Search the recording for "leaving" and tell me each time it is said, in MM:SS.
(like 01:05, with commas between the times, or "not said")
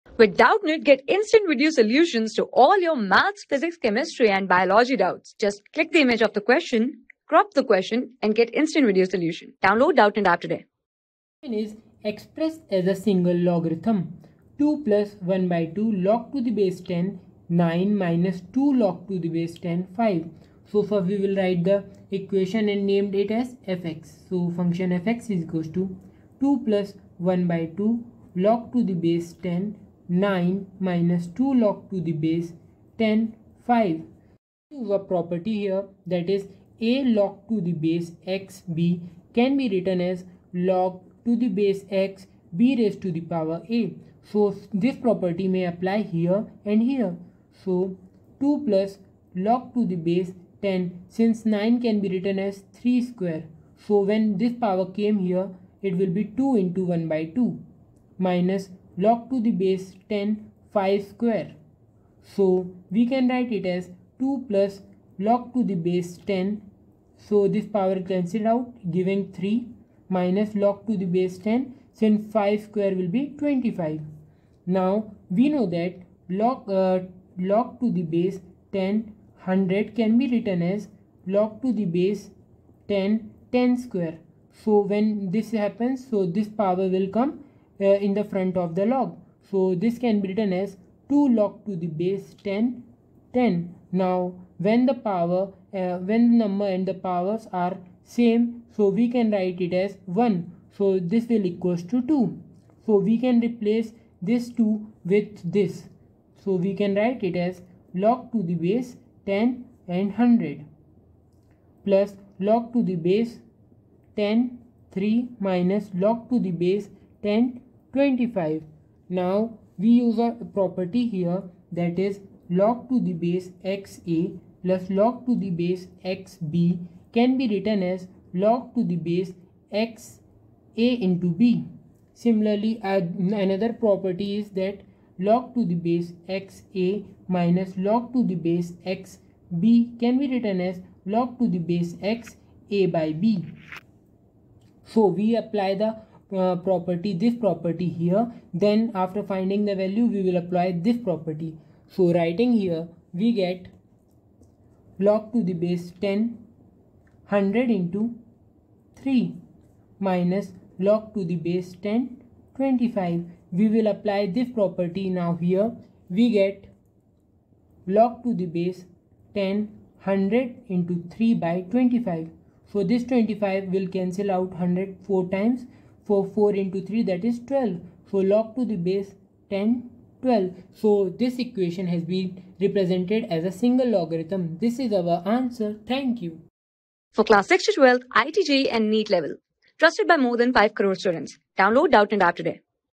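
not said.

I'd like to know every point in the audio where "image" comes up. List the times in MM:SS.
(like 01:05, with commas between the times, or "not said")
00:06.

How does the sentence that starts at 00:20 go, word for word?
So first we will write the equation and named it as fx.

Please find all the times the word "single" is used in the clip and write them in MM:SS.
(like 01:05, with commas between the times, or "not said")
00:12, 03:03.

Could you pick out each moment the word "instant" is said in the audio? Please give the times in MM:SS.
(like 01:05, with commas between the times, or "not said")
00:01, 00:08.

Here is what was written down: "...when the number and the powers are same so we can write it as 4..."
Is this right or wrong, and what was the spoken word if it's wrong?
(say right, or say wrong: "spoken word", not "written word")
wrong: "1", not "4".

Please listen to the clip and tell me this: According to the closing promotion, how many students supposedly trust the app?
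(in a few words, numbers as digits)
more than 5 crore.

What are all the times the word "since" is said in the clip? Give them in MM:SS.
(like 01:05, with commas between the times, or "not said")
00:51, 01:11.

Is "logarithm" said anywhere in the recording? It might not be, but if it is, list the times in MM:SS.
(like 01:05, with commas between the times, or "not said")
00:13, 03:03.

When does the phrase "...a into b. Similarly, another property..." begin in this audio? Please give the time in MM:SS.
02:10.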